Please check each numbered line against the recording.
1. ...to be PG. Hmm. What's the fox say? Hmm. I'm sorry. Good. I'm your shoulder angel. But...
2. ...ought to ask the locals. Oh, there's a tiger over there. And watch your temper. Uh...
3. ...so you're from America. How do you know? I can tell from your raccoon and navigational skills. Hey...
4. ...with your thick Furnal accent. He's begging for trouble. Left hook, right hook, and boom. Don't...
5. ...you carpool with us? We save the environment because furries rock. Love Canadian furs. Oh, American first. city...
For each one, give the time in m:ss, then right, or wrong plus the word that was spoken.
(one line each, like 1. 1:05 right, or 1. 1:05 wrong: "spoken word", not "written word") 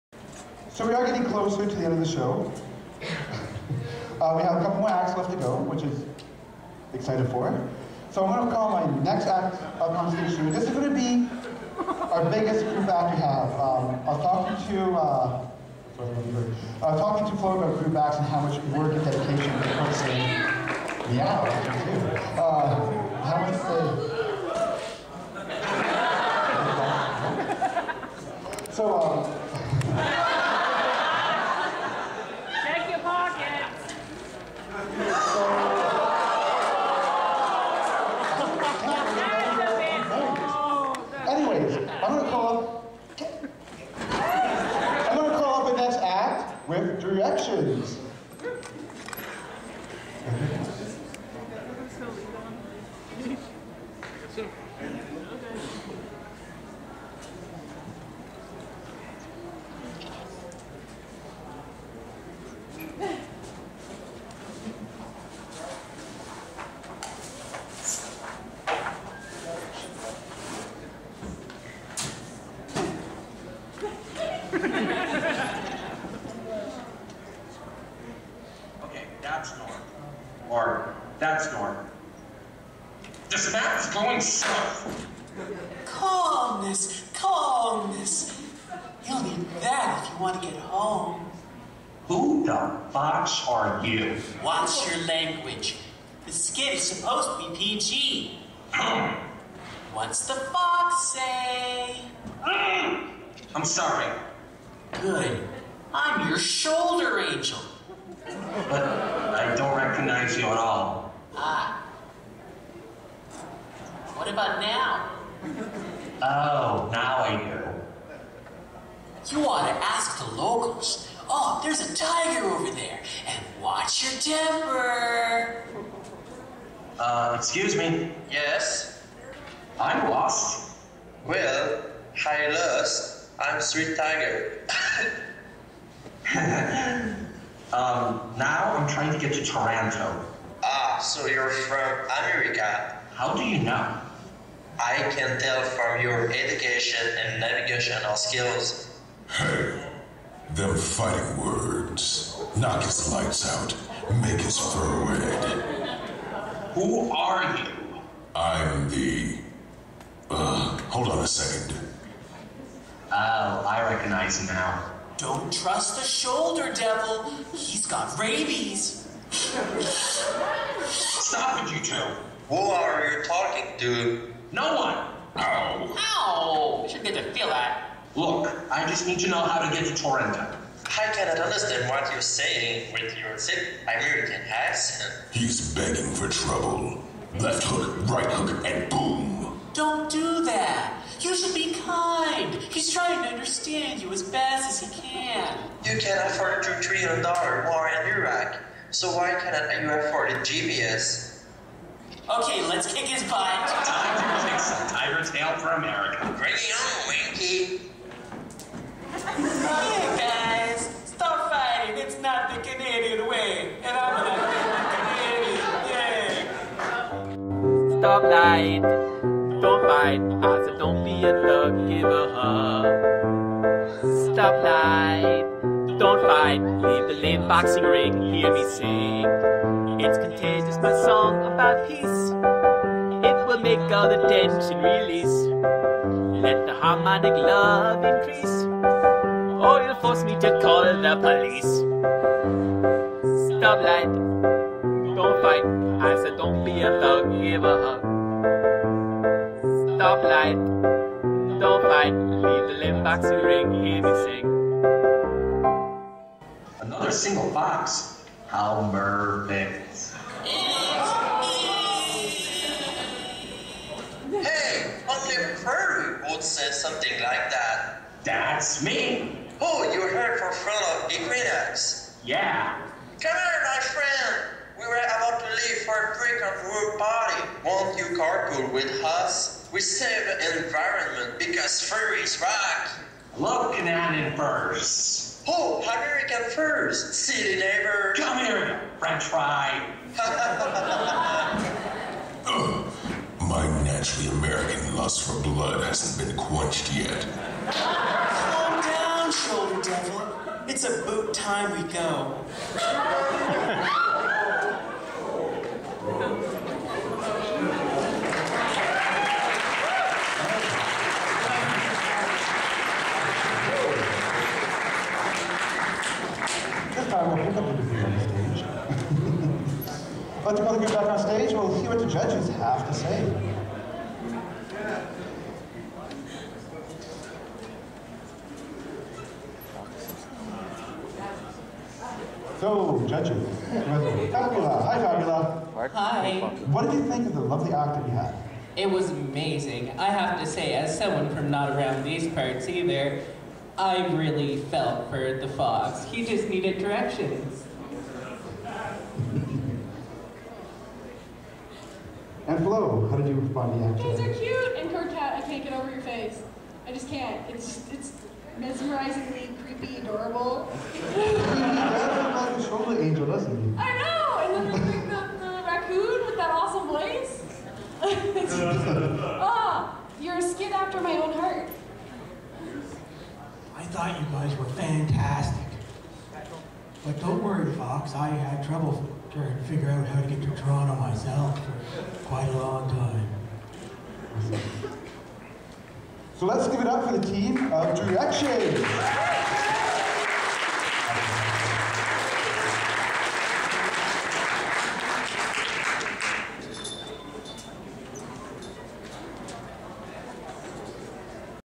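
1. 1:37 right
2. 1:59 right
3. 2:20 wrong: "education", not "raccoon"
4. 3:02 wrong: "American", not "Furnal"
5. 4:37 right.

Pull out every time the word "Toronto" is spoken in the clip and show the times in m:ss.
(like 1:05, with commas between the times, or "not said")
2:19, 2:59, 6:20.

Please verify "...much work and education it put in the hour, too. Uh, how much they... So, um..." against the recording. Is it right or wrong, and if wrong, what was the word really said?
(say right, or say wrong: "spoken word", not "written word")
wrong: "dedication", not "education".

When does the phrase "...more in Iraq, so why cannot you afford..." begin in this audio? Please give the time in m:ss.
3:17.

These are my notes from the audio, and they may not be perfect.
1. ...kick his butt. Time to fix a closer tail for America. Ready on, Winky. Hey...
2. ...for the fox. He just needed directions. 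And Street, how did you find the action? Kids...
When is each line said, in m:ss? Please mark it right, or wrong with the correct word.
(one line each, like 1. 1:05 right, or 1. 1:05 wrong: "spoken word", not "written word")
1. 3:22 wrong: "tiger", not "closer"
2. 5:45 wrong: "Flo", not "Street".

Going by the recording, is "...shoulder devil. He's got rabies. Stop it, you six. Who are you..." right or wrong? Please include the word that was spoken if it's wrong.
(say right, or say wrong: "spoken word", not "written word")
wrong: "two", not "six".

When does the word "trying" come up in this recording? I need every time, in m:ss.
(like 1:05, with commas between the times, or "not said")
2:18, 3:12, 6:19.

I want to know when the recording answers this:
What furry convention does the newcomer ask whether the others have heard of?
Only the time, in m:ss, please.
4:30.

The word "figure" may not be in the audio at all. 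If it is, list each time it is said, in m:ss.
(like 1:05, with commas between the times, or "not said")
6:19.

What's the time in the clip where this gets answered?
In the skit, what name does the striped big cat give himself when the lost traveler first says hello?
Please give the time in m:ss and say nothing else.
2:13.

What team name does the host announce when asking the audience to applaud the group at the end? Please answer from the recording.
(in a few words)
Direction.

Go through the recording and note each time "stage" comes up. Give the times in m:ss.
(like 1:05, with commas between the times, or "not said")
0:10, 5:21.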